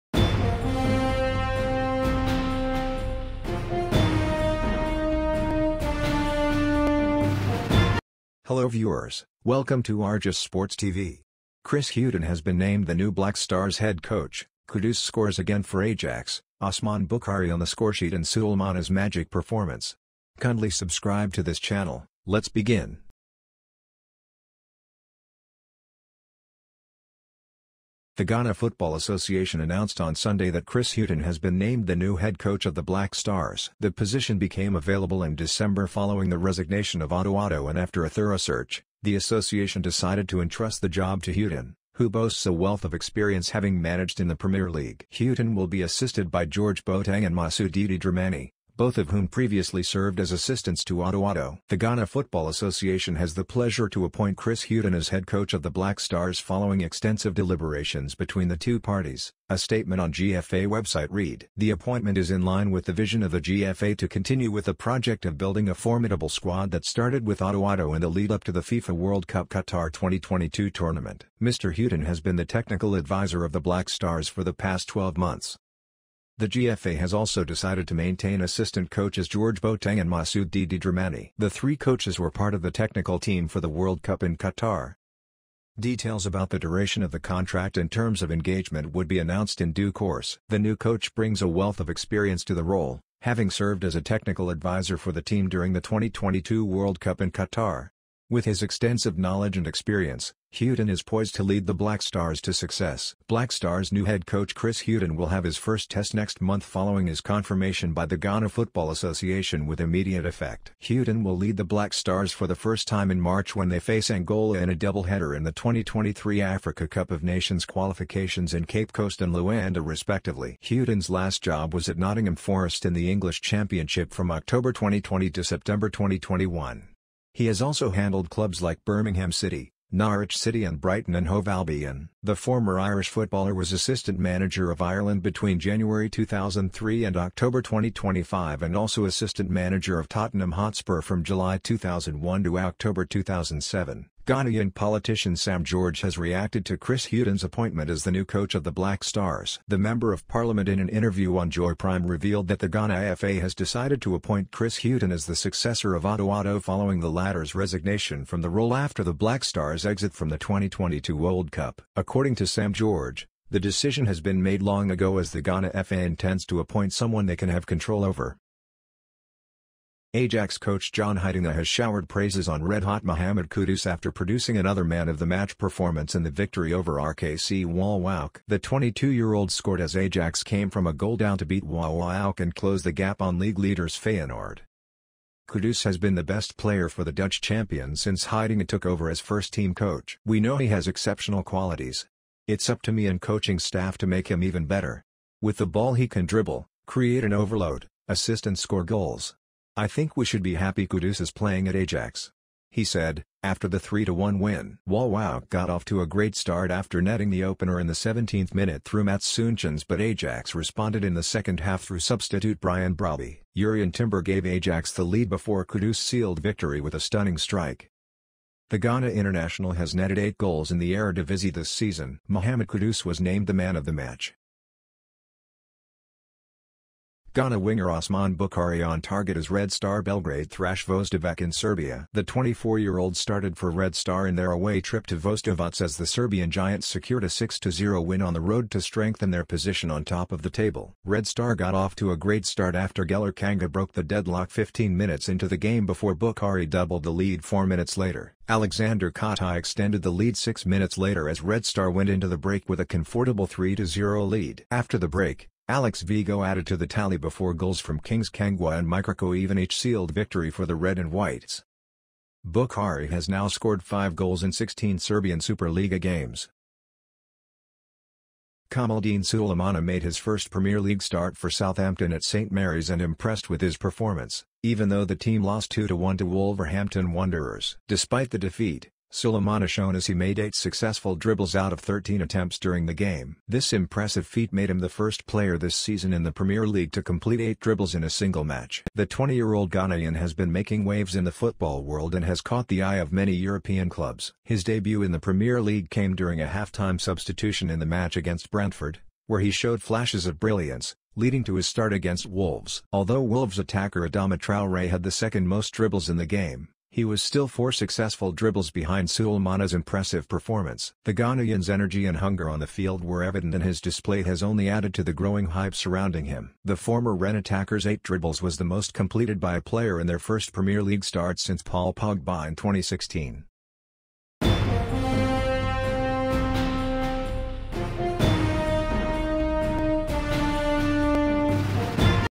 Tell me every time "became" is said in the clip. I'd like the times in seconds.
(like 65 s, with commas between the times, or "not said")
34 s.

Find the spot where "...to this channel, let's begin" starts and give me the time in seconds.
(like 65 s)
21 s.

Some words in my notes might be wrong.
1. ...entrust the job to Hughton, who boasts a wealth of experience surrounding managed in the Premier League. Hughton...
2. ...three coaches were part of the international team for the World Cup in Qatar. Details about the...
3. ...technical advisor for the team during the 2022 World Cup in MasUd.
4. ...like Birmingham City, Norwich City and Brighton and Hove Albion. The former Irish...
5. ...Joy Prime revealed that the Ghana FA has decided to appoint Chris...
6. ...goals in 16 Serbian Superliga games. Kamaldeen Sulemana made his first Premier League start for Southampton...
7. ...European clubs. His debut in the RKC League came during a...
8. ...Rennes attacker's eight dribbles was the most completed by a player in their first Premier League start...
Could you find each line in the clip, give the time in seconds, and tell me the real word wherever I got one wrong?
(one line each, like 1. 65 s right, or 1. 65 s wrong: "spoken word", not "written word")
1. 40 s wrong: "having", not "surrounding"
2. 81 s wrong: "technical", not "international"
3. 94 s wrong: "Qatar", not "MasUd"
4. 128 s right
5. 151 s right
6. 264 s right
7. 293 s wrong: "Premier", not "RKC"
8. 317 s right.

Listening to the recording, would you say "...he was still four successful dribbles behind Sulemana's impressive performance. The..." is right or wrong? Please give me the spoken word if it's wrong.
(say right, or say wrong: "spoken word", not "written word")
right.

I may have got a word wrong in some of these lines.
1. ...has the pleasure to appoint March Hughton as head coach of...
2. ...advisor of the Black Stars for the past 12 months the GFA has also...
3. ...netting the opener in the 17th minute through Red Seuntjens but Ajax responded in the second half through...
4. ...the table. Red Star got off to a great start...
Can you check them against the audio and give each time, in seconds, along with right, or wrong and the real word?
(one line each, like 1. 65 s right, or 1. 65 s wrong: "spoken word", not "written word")
1. 53 s wrong: "Chris", not "March"
2. 72 s right
3. 207 s wrong: "Mats", not "Red"
4. 240 s right.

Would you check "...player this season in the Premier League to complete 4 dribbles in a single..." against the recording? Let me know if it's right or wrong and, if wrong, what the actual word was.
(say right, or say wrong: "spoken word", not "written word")
wrong: "8", not "4".